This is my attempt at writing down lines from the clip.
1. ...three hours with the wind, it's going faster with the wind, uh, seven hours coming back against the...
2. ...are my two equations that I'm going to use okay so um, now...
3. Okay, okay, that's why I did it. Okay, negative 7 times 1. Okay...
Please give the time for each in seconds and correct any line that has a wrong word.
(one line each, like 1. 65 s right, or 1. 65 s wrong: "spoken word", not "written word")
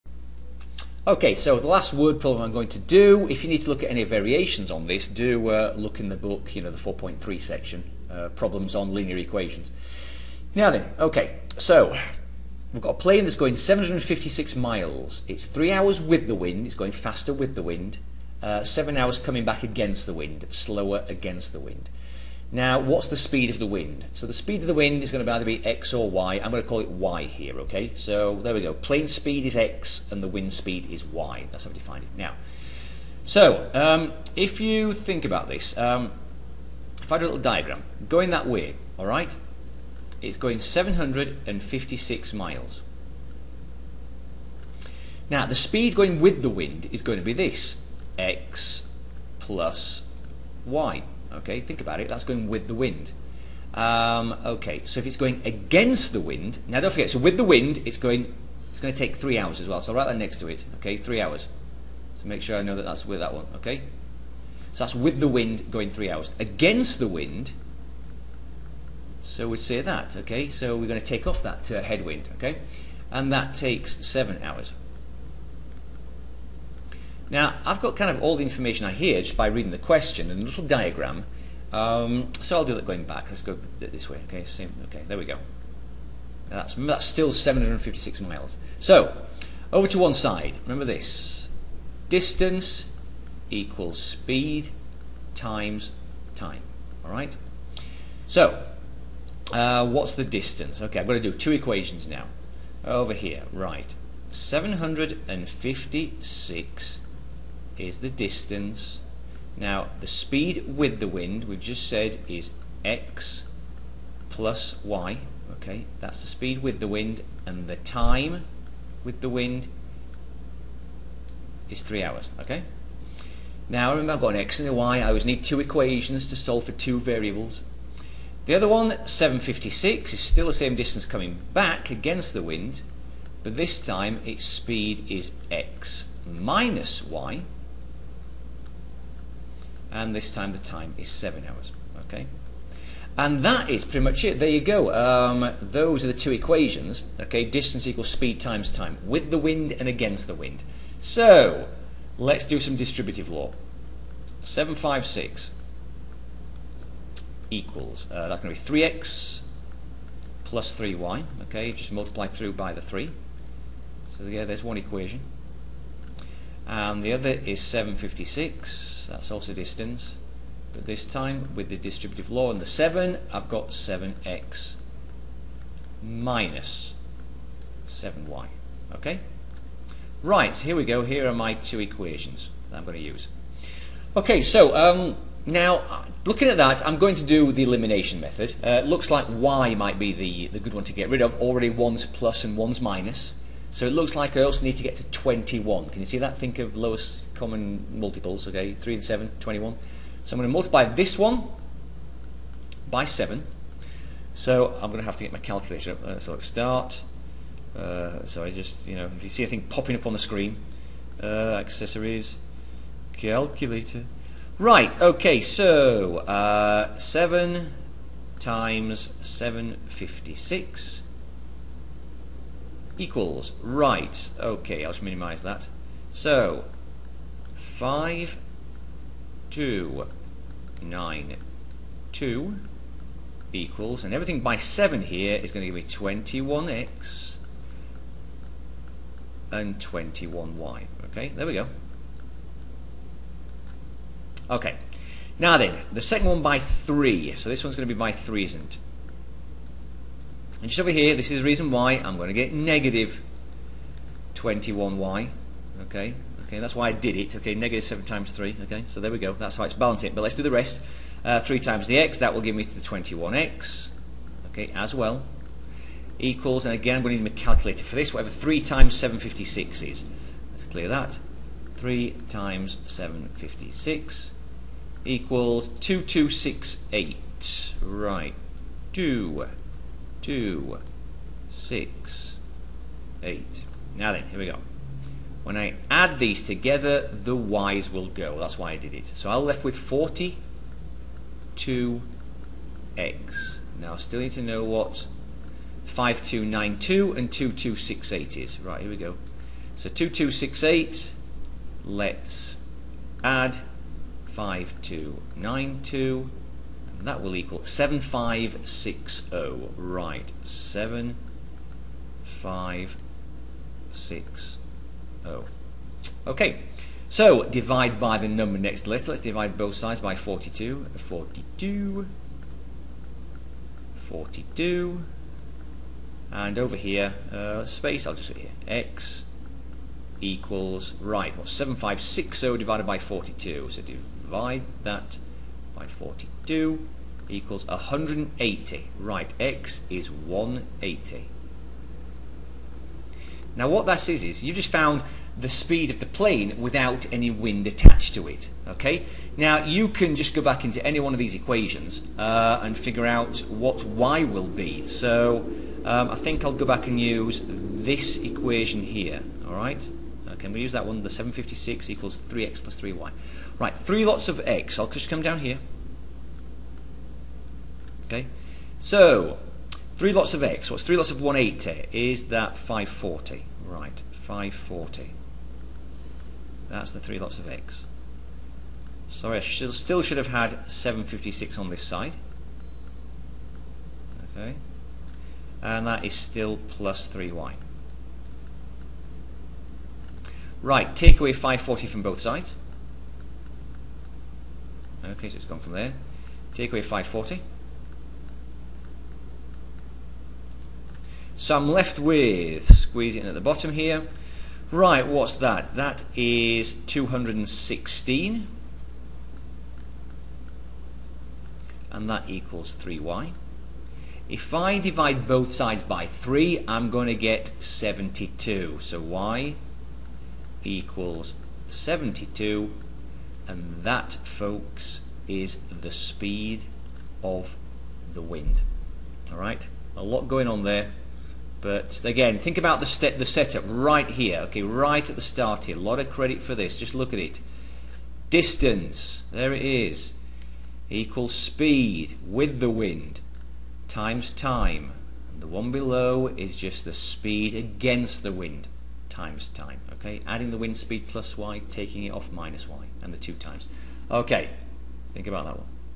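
1. 15 s right
2. 181 s right
3. 255 s wrong: "3", not "1".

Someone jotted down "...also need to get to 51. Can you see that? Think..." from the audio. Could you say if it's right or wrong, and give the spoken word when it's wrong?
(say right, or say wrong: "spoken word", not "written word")
wrong: "21", not "51".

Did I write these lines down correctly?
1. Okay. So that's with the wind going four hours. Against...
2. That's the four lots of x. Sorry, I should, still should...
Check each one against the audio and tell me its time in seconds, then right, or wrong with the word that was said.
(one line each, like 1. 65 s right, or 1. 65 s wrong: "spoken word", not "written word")
1. 63 s wrong: "three", not "four"
2. 376 s wrong: "three", not "four".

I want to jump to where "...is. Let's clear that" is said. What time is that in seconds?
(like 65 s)
269 s.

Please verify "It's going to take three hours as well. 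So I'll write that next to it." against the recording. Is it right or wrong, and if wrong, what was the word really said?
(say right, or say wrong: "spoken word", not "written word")
right.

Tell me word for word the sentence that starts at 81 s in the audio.
Um, so I'll do that going back.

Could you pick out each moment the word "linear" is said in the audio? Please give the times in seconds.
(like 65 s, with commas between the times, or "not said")
8 s.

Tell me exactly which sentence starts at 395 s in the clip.
Okay, so it's gone from there.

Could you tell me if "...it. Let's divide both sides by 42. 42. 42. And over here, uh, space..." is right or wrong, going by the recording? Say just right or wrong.
right.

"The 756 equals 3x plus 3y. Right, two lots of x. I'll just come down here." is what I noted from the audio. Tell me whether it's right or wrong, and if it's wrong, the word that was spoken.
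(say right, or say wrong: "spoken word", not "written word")
wrong: "three", not "two".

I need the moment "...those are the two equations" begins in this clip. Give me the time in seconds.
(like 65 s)
145 s.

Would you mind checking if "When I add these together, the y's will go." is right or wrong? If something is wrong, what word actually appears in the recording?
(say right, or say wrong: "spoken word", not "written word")
right.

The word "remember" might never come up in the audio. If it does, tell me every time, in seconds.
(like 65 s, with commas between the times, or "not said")
90 s, 123 s.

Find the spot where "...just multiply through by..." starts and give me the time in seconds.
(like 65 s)
161 s.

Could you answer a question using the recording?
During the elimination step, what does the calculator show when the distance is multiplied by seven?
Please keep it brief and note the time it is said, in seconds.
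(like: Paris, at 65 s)
5292, at 227 s.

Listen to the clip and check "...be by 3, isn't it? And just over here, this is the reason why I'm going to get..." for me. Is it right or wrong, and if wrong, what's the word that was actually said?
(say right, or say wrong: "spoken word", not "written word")
right.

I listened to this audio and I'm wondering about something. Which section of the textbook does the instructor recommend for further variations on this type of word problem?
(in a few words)
4.3.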